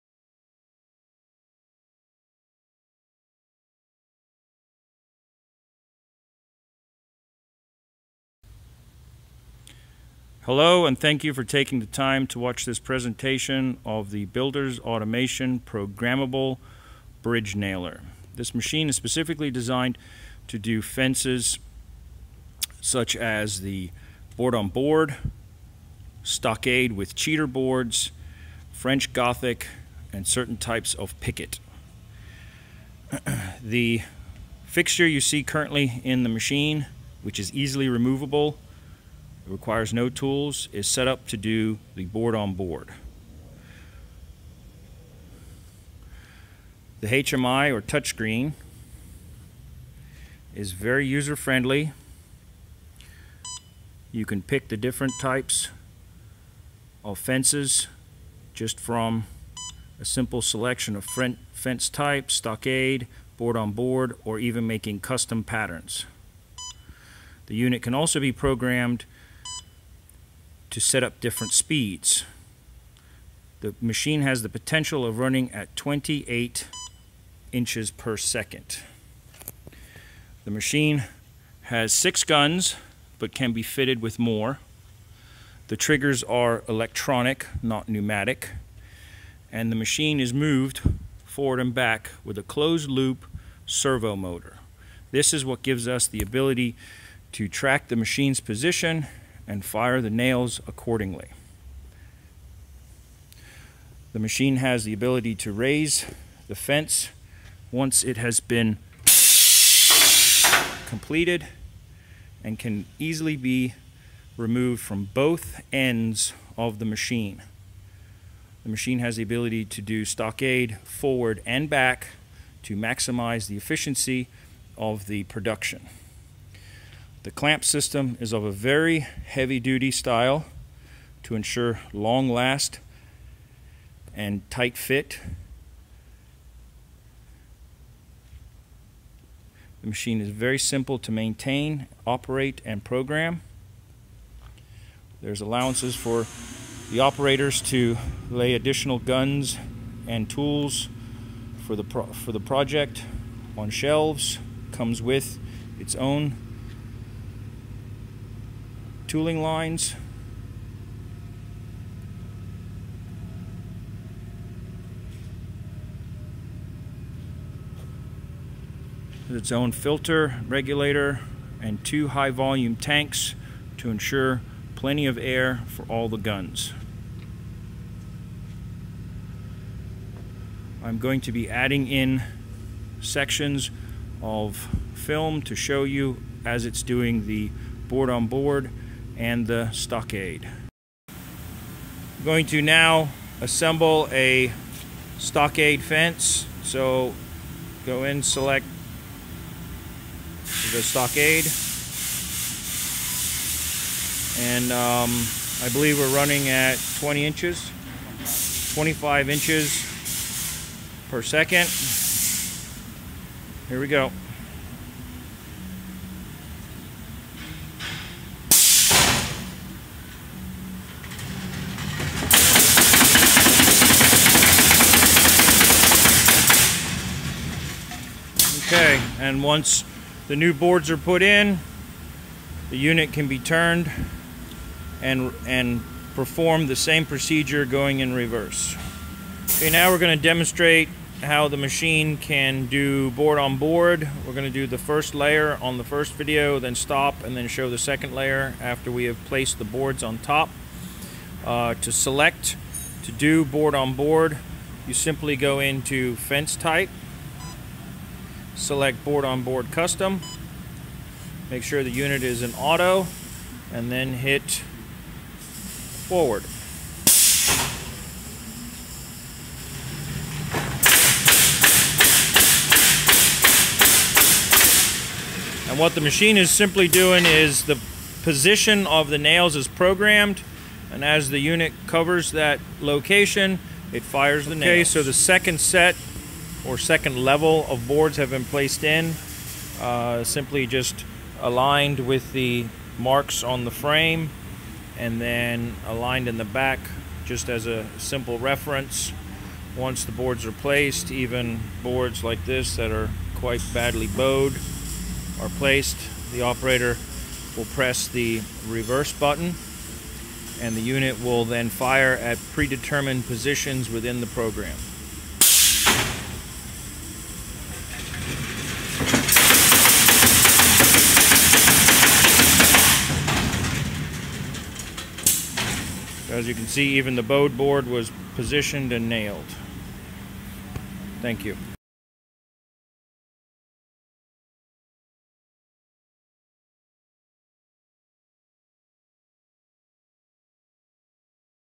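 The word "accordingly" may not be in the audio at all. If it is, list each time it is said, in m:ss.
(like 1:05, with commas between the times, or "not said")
1:40.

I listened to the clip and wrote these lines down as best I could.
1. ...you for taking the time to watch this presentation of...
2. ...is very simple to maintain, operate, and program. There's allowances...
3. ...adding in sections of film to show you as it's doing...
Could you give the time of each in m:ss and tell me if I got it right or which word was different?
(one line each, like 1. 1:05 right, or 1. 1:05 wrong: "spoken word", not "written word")
1. 0:11 right
2. 2:20 right
3. 3:01 right.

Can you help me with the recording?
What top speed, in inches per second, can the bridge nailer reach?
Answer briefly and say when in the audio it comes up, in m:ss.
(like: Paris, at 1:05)
28 inches per second, at 1:15.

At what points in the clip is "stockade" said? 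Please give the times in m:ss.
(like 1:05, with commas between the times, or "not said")
0:26, 1:02, 2:00, 3:09, 3:15, 3:20.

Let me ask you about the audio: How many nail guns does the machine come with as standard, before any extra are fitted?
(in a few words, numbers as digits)
6.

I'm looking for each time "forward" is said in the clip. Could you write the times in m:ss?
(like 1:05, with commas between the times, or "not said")
1:31, 2:00, 4:26.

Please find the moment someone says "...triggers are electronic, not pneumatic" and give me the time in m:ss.
1:25.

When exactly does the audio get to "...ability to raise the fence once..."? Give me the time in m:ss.
1:44.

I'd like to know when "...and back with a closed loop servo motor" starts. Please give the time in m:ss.
1:31.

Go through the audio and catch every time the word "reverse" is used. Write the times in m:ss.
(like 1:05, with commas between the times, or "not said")
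3:58, 5:08.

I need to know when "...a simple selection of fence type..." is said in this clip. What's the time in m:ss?
0:59.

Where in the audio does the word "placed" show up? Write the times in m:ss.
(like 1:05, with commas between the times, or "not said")
4:09, 4:48, 5:00, 5:05.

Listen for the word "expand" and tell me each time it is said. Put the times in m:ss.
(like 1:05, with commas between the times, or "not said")
not said.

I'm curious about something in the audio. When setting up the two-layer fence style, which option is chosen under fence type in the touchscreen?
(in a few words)
board on board custom.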